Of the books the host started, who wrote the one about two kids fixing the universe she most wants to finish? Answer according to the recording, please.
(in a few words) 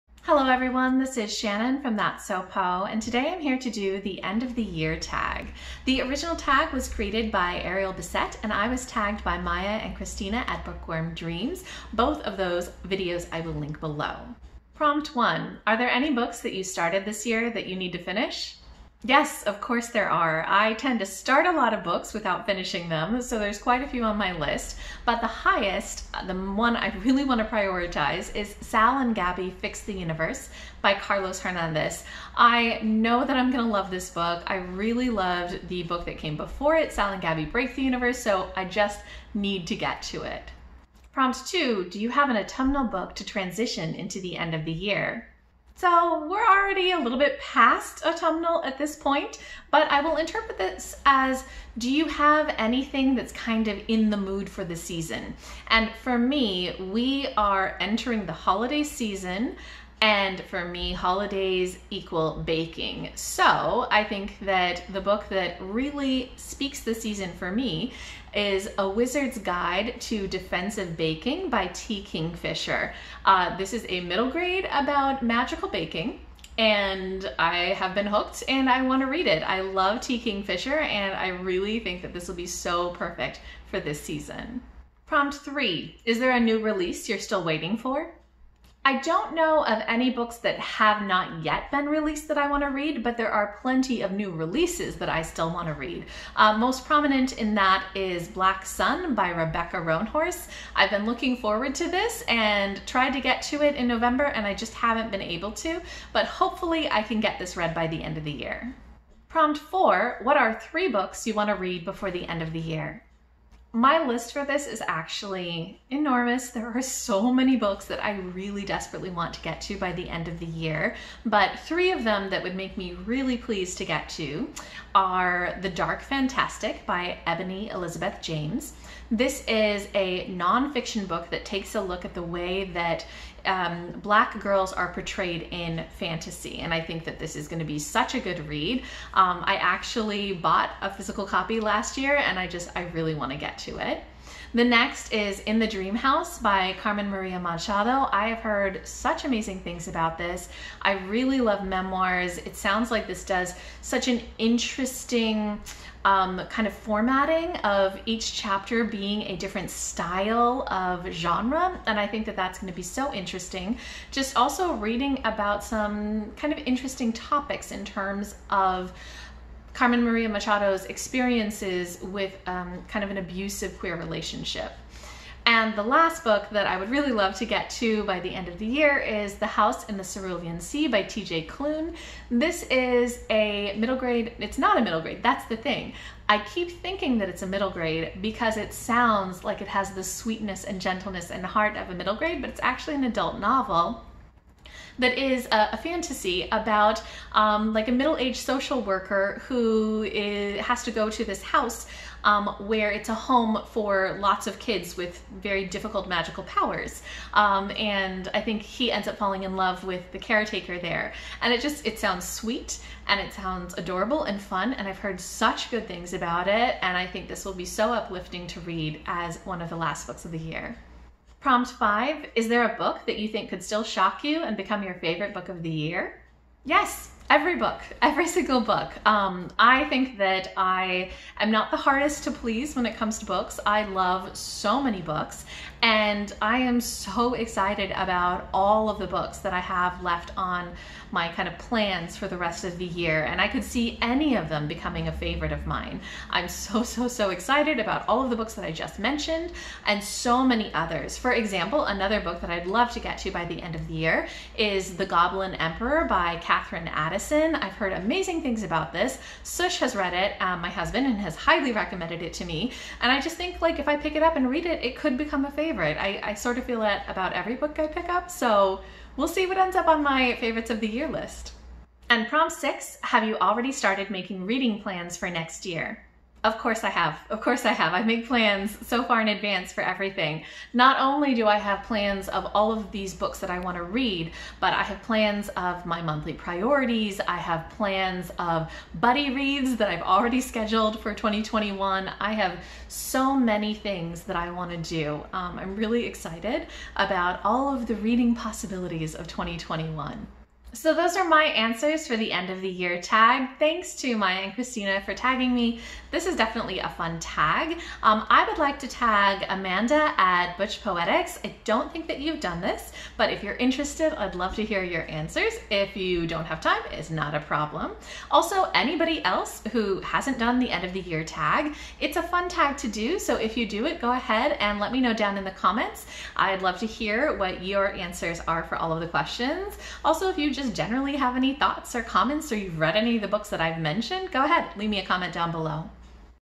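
Carlos Hernandez.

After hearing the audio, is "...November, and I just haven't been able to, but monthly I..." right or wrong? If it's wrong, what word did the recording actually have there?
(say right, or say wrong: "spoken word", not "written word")
wrong: "hopefully", not "monthly".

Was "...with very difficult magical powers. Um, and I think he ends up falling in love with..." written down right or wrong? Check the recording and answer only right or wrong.
right.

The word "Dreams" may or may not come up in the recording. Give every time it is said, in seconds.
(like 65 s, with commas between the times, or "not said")
11 s, 145 s.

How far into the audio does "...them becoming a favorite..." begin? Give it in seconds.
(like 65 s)
244 s.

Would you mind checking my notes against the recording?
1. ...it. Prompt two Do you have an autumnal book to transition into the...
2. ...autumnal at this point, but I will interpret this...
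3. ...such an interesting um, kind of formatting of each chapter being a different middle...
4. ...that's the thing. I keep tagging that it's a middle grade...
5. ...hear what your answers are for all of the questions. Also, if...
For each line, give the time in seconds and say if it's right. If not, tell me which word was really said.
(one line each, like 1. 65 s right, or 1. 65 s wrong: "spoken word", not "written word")
1. 40 s right
2. 48 s right
3. 153 s wrong: "style", not "middle"
4. 185 s wrong: "thinking", not "tagging"
5. 326 s right.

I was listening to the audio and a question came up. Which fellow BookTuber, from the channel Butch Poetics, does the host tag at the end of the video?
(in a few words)
Amanda.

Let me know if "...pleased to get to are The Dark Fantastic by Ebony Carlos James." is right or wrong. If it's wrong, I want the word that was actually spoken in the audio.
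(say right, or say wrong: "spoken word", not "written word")
wrong: "Elizabeth", not "Carlos".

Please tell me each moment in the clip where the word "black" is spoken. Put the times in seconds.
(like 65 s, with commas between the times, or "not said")
98 s, 134 s.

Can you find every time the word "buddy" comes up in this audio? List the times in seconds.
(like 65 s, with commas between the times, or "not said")
288 s.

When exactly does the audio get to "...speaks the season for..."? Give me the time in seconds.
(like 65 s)
66 s.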